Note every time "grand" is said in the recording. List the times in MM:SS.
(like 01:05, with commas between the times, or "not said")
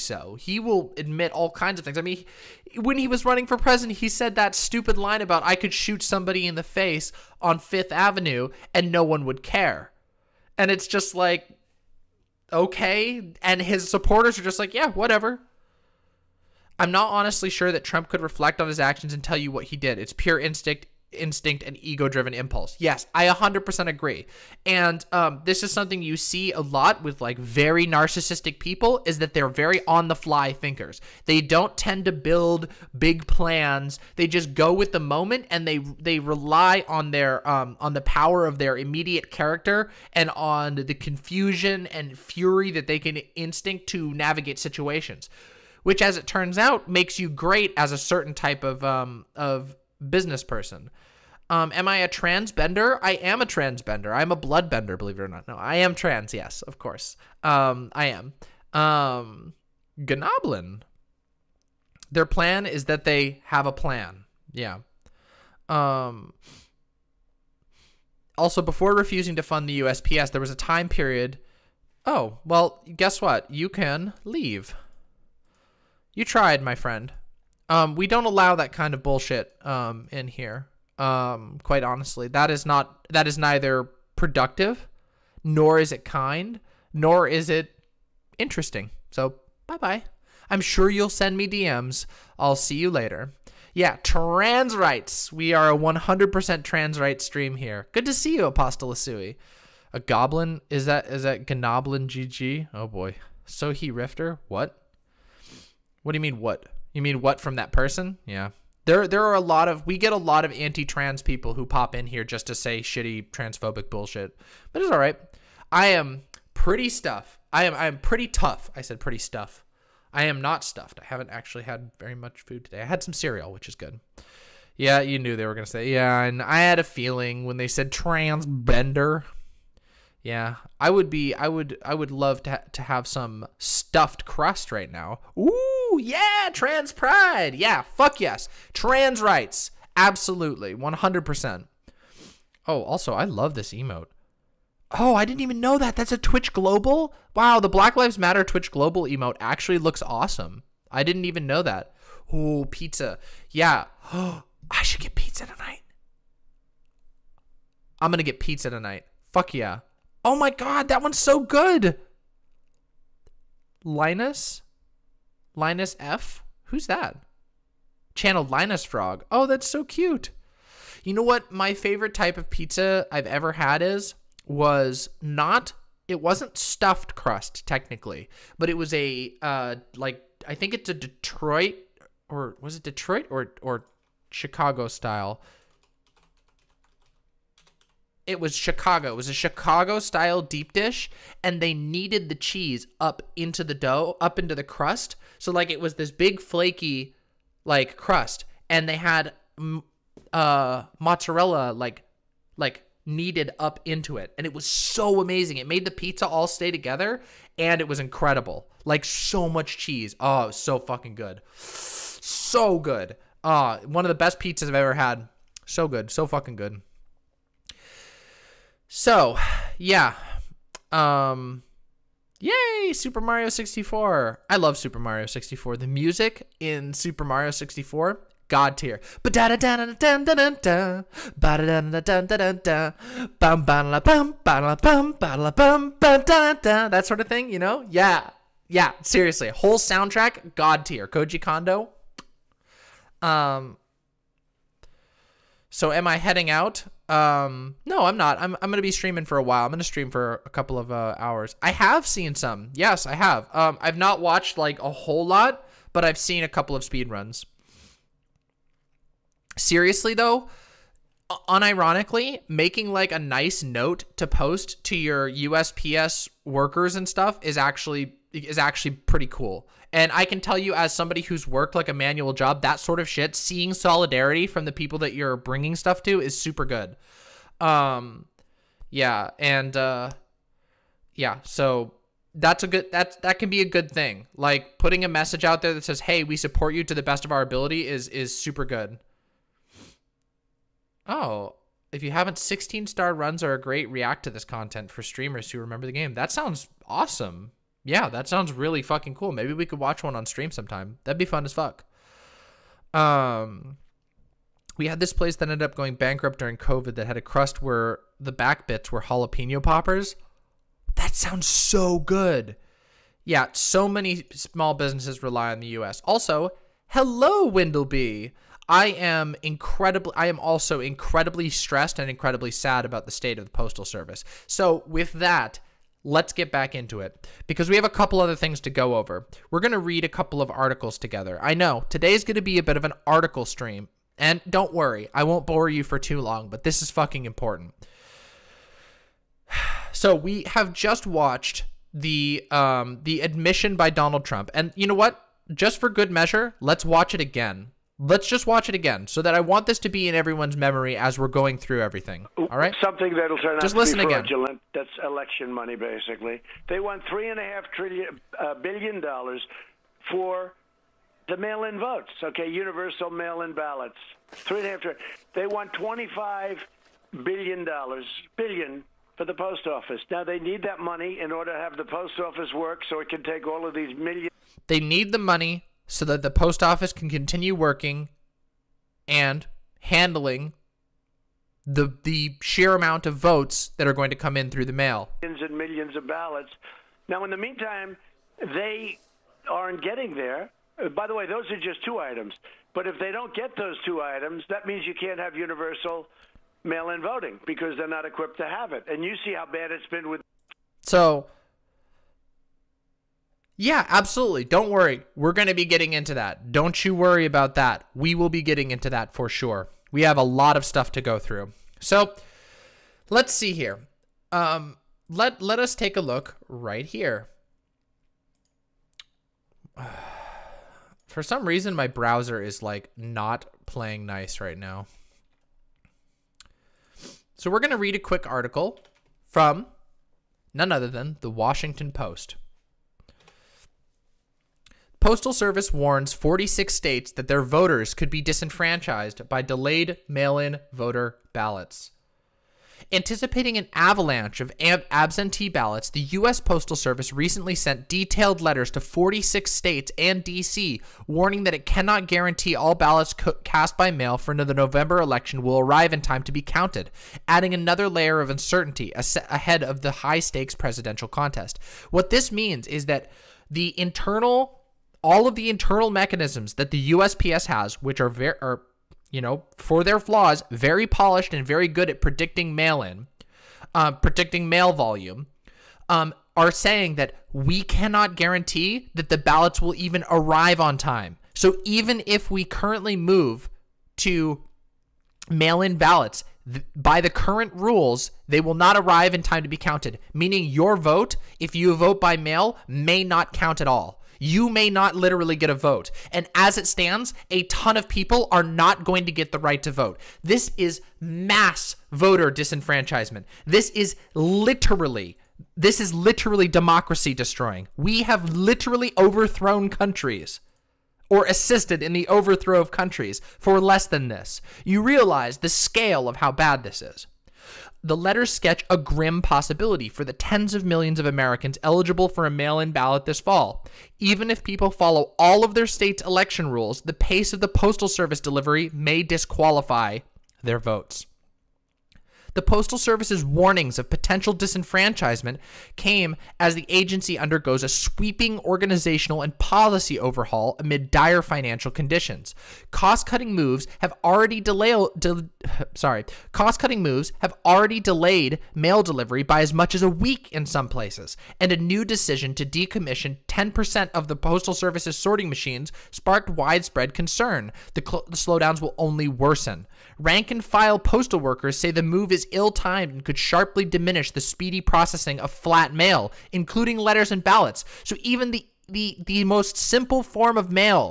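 not said.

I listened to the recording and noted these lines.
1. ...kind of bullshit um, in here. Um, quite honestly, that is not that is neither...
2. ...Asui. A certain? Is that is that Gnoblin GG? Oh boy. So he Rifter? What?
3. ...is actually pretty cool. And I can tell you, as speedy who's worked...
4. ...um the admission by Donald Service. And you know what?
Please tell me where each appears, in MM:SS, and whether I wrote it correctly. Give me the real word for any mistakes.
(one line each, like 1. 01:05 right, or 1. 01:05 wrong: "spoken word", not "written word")
1. 01:18 right
2. 01:38 wrong: "goblin", not "certain"
3. 04:28 wrong: "somebody", not "speedy"
4. 05:42 wrong: "Trump", not "Service".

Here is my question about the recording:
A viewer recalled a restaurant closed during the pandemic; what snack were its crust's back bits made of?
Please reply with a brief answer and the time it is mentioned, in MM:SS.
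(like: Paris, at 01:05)
jalapeno poppers, at 05:09.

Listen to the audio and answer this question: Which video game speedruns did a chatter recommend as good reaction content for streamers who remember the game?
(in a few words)
16 star runs.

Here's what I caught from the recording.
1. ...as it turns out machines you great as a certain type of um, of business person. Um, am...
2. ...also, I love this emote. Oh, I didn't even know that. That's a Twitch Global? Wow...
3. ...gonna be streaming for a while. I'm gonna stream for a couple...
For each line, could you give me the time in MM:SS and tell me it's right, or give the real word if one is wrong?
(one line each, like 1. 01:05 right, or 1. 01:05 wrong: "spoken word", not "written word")
1. 00:46 wrong: "makes", not "machines"
2. 02:22 right
3. 04:08 right.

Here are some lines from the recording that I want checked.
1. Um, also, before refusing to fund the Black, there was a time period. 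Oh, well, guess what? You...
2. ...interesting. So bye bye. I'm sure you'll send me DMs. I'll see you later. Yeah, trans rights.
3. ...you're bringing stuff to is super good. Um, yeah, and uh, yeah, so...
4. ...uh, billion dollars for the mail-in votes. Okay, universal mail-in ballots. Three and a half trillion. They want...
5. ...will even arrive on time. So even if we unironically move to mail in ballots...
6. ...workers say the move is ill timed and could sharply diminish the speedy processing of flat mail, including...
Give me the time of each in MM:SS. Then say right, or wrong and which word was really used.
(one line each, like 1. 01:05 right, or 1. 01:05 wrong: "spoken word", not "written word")
1. 01:05 wrong: "USPS", not "Black"
2. 01:28 right
3. 04:35 right
4. 05:58 right
5. 07:59 wrong: "currently", not "unironically"
6. 09:21 right.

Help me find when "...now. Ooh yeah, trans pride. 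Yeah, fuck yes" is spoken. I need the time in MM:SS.
02:14.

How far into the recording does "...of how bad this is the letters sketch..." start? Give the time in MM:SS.
08:36.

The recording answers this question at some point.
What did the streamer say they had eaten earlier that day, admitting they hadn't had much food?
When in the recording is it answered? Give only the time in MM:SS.
02:03.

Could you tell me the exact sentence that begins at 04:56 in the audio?
That sounds awesome yeah, that sounds really fucking cool.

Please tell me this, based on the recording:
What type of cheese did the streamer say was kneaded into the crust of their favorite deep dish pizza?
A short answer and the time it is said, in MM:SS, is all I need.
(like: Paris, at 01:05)
mozzarella, at 03:20.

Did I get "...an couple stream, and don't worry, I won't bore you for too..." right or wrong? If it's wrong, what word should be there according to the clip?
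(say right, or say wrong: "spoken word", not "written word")
wrong: "article", not "couple".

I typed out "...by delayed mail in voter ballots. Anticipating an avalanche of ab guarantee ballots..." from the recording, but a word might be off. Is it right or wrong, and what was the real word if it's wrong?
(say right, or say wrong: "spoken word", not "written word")
wrong: "absentee", not "guarantee".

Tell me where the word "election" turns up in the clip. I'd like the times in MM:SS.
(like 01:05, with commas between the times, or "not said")
05:55, 07:35, 08:46.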